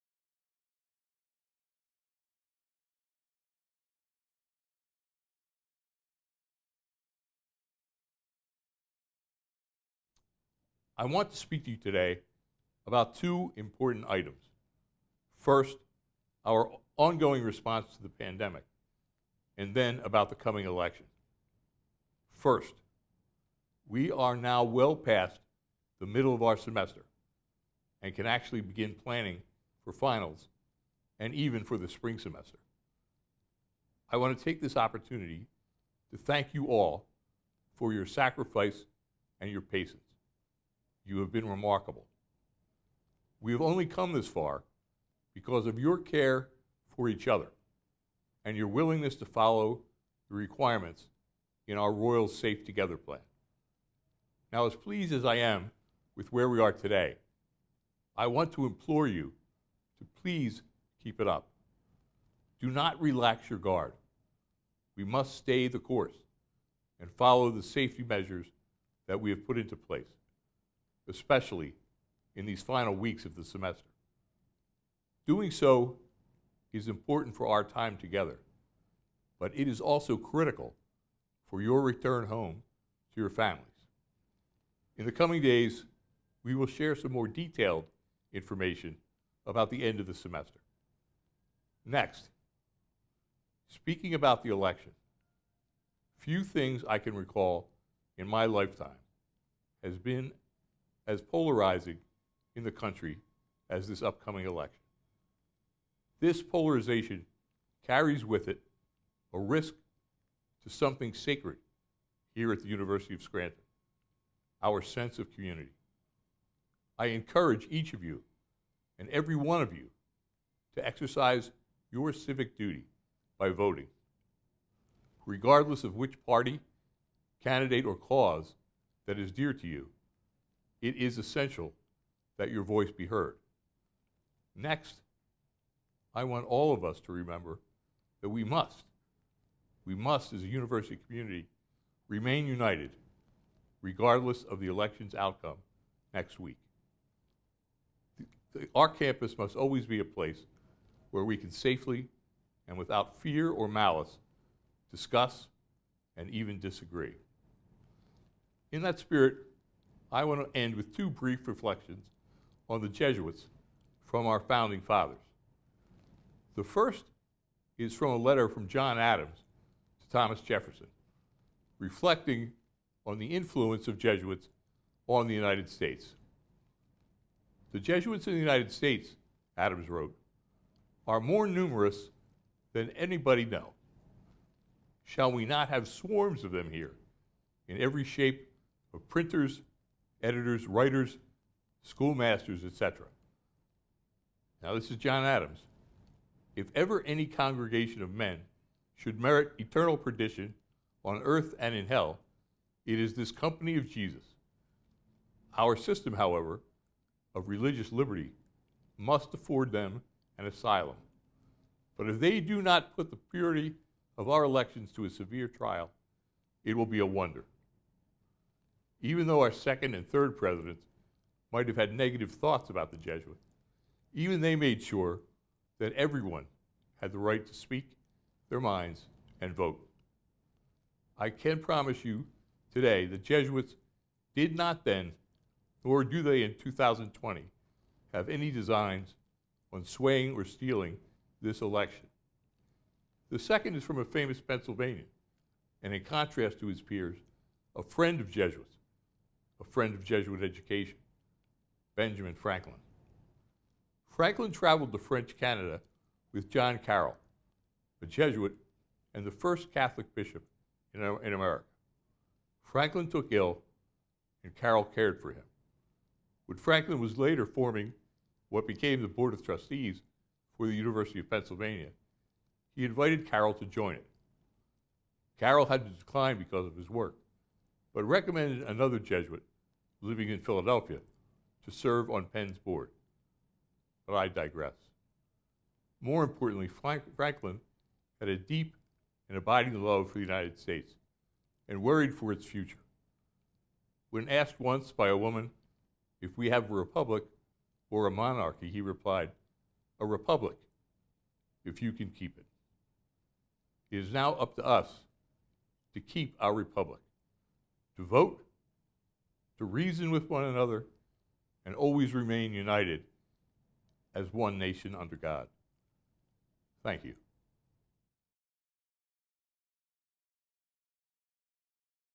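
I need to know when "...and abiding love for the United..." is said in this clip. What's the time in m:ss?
4:49.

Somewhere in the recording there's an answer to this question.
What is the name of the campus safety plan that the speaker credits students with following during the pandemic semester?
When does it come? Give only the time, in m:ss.
0:51.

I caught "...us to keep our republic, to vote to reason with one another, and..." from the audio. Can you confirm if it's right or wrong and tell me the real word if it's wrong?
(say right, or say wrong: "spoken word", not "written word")
right.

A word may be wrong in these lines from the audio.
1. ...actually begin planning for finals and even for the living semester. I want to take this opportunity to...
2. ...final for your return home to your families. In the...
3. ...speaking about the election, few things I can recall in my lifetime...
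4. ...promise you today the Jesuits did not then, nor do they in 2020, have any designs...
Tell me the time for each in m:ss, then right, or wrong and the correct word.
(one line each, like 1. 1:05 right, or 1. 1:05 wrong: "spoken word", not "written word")
1. 0:28 wrong: "spring", not "living"
2. 1:20 wrong: "critical", not "final"
3. 1:33 right
4. 3:51 right.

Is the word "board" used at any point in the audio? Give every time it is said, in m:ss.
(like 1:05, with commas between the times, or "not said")
4:29, 4:42.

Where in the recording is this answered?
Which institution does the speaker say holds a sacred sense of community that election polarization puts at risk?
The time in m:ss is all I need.
1:52.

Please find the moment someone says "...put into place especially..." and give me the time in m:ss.
1:09.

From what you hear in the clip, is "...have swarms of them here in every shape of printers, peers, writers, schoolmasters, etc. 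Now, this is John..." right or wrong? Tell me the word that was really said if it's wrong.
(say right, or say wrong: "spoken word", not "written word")
wrong: "editors", not "peers".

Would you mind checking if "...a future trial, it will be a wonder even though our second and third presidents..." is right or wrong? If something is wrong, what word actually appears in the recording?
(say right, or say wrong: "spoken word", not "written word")
wrong: "severe", not "future".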